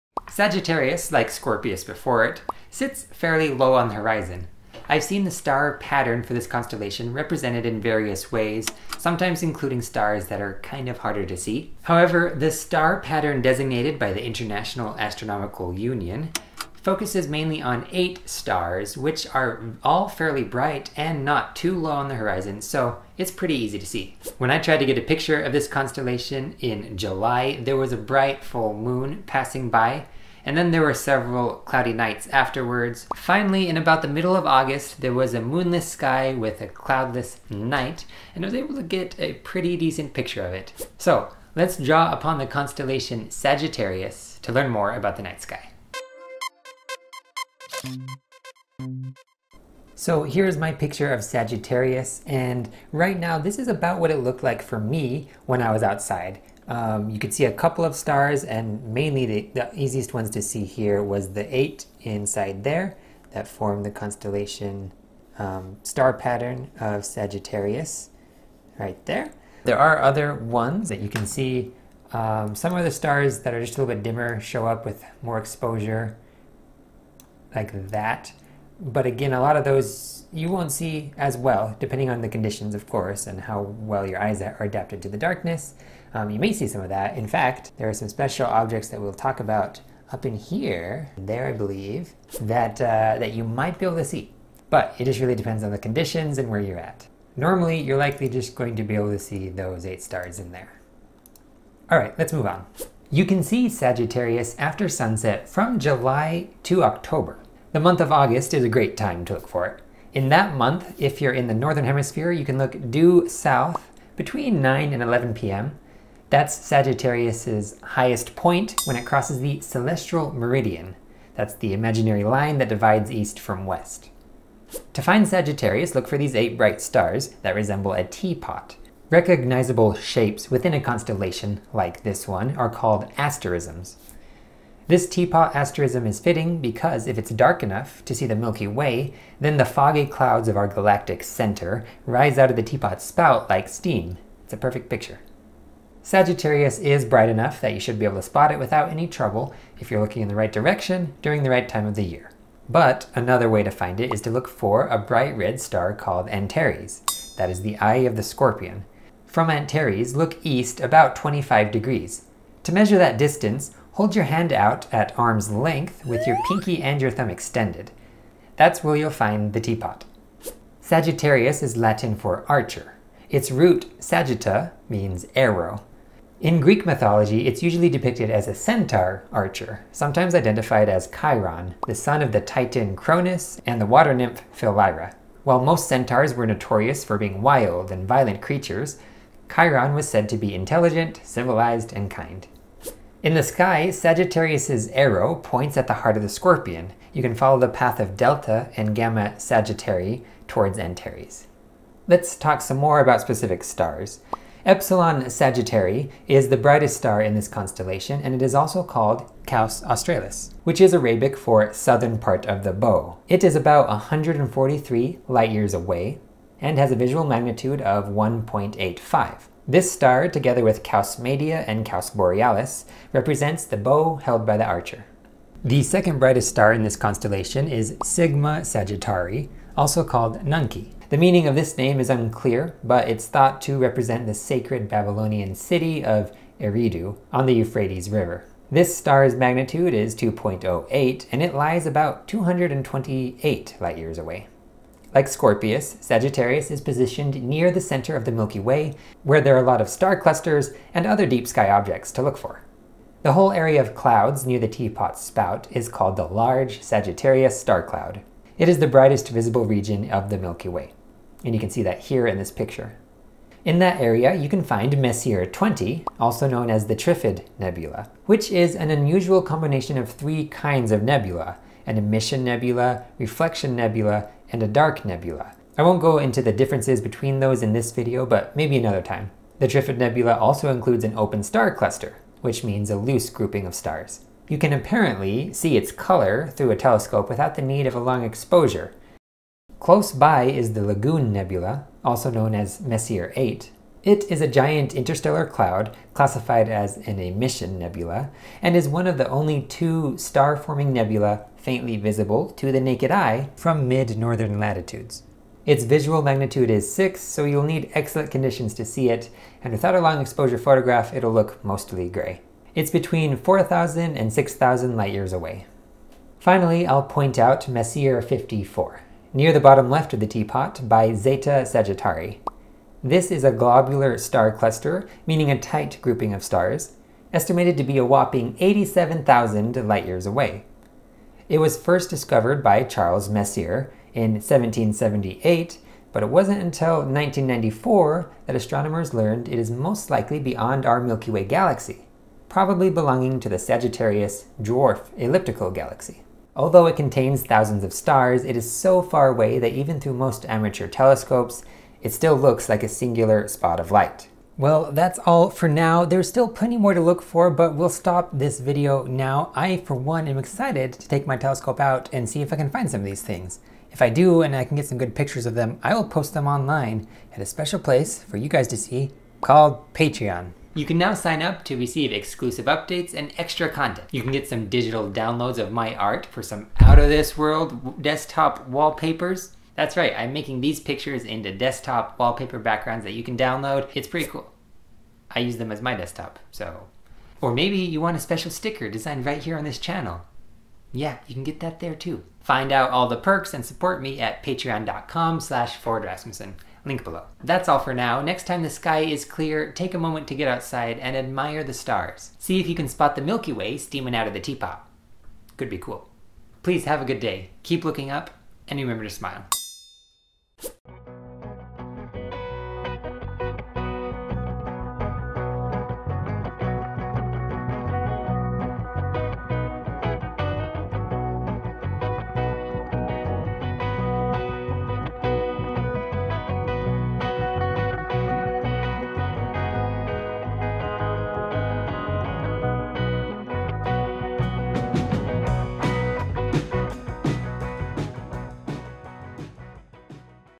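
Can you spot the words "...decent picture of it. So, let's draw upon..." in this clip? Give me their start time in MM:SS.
00:39.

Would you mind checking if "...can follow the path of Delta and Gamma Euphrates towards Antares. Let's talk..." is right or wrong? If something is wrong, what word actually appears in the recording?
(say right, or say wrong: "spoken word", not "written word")
wrong: "Sagittarii", not "Euphrates".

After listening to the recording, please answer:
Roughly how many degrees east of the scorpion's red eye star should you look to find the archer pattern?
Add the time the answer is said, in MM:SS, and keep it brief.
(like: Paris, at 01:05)
25 degrees, at 02:41.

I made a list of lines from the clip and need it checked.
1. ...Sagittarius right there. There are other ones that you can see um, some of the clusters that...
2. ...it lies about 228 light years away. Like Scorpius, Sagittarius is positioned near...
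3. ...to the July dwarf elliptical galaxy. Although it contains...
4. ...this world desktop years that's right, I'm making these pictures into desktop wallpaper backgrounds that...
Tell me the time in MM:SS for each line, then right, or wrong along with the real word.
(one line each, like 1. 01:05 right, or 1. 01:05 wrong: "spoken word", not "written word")
1. 01:07 wrong: "stars", not "clusters"
2. 04:01 right
3. 05:43 wrong: "Sagittarius", not "July"
4. 06:17 wrong: "wallpapers", not "years".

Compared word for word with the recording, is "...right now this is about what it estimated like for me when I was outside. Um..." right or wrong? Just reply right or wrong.
wrong.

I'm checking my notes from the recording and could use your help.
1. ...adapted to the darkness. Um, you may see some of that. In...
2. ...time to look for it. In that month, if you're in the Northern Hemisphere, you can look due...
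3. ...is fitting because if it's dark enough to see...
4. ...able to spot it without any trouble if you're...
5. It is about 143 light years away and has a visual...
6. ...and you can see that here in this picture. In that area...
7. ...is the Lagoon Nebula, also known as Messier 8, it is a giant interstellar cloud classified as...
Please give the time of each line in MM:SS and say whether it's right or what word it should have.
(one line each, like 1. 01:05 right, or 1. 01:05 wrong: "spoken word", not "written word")
1. 01:24 right
2. 01:48 right
3. 02:16 right
4. 02:28 right
5. 03:33 right
6. 04:21 right
7. 04:50 right.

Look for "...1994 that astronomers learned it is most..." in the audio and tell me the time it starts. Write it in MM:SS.
05:36.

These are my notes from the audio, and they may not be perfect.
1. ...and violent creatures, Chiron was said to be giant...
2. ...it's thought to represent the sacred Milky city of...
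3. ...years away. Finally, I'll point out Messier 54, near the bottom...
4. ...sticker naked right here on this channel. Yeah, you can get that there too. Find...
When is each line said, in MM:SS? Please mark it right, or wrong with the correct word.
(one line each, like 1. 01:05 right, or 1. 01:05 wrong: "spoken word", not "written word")
1. 03:07 wrong: "intelligent", not "giant"
2. 03:53 wrong: "Babylonian", not "Milky"
3. 05:15 right
4. 06:28 wrong: "designed", not "naked".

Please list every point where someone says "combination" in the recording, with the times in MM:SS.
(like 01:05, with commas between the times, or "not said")
04:29.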